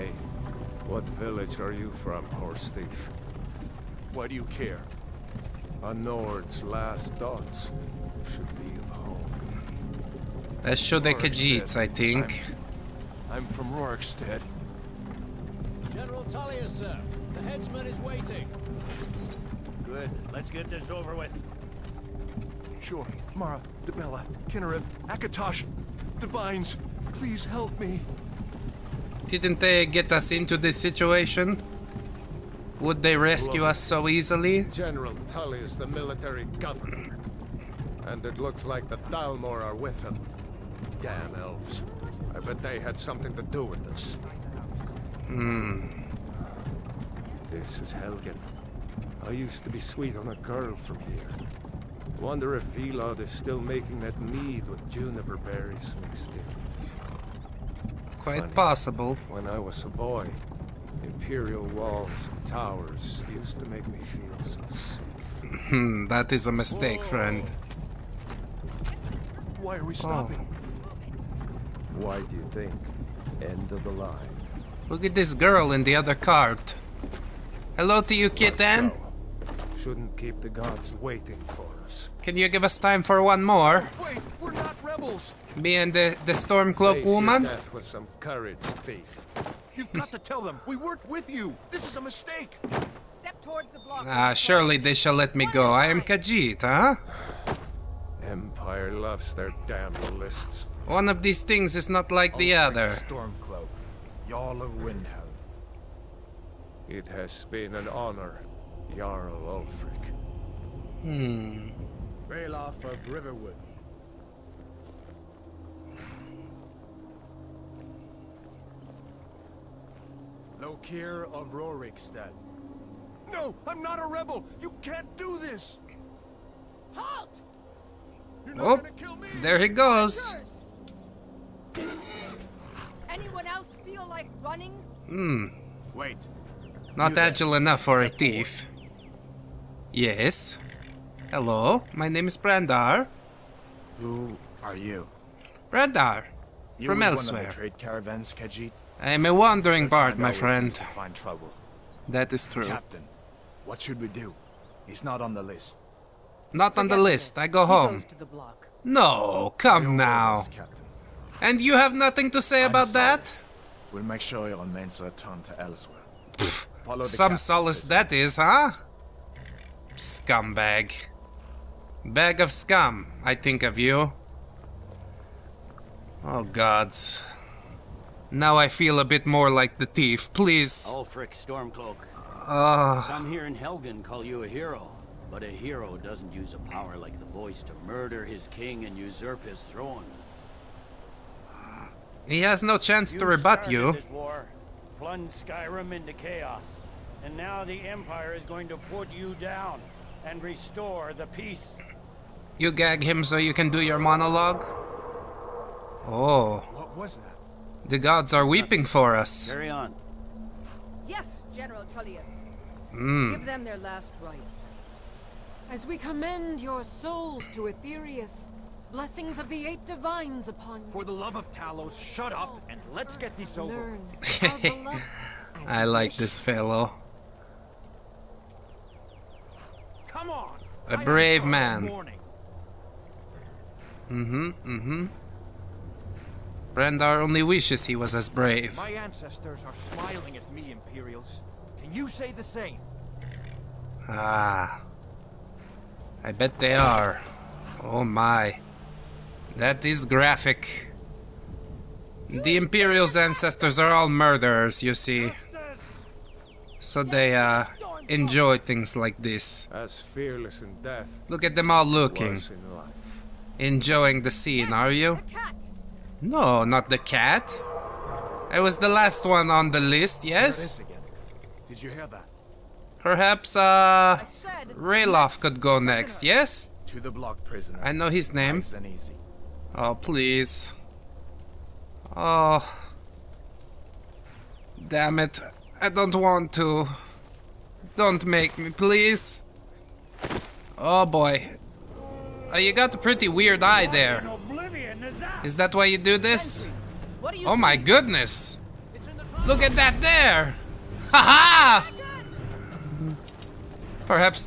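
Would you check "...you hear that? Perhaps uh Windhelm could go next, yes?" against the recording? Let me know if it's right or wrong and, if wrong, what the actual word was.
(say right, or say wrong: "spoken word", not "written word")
wrong: "Ralof", not "Windhelm".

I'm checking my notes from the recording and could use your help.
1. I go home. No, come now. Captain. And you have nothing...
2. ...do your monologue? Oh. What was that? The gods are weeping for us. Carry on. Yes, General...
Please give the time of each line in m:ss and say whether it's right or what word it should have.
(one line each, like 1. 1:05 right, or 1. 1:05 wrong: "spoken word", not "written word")
1. 2:37 right
2. 3:23 right.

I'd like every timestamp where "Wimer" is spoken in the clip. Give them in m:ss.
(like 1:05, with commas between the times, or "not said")
not said.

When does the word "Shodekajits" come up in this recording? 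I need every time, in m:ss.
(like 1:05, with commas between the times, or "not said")
0:10.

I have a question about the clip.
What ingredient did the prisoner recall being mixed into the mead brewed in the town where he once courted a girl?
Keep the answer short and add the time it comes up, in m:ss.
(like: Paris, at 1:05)
juniper berries, at 0:54.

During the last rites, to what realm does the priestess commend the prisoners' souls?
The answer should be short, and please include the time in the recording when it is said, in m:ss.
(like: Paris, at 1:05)
Aetherius, at 3:37.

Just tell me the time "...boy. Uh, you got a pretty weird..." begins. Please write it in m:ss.
4:51.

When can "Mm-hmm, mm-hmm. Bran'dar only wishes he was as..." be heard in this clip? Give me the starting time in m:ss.
3:54.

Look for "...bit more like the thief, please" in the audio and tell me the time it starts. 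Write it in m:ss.
2:59.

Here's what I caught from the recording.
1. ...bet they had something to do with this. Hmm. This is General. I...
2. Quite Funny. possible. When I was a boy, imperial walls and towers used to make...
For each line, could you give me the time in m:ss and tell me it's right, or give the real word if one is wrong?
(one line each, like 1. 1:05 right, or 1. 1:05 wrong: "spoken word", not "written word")
1. 0:42 wrong: "Helgen", not "General"
2. 0:58 right.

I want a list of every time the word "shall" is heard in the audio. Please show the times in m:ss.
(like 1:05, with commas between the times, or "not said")
1:34.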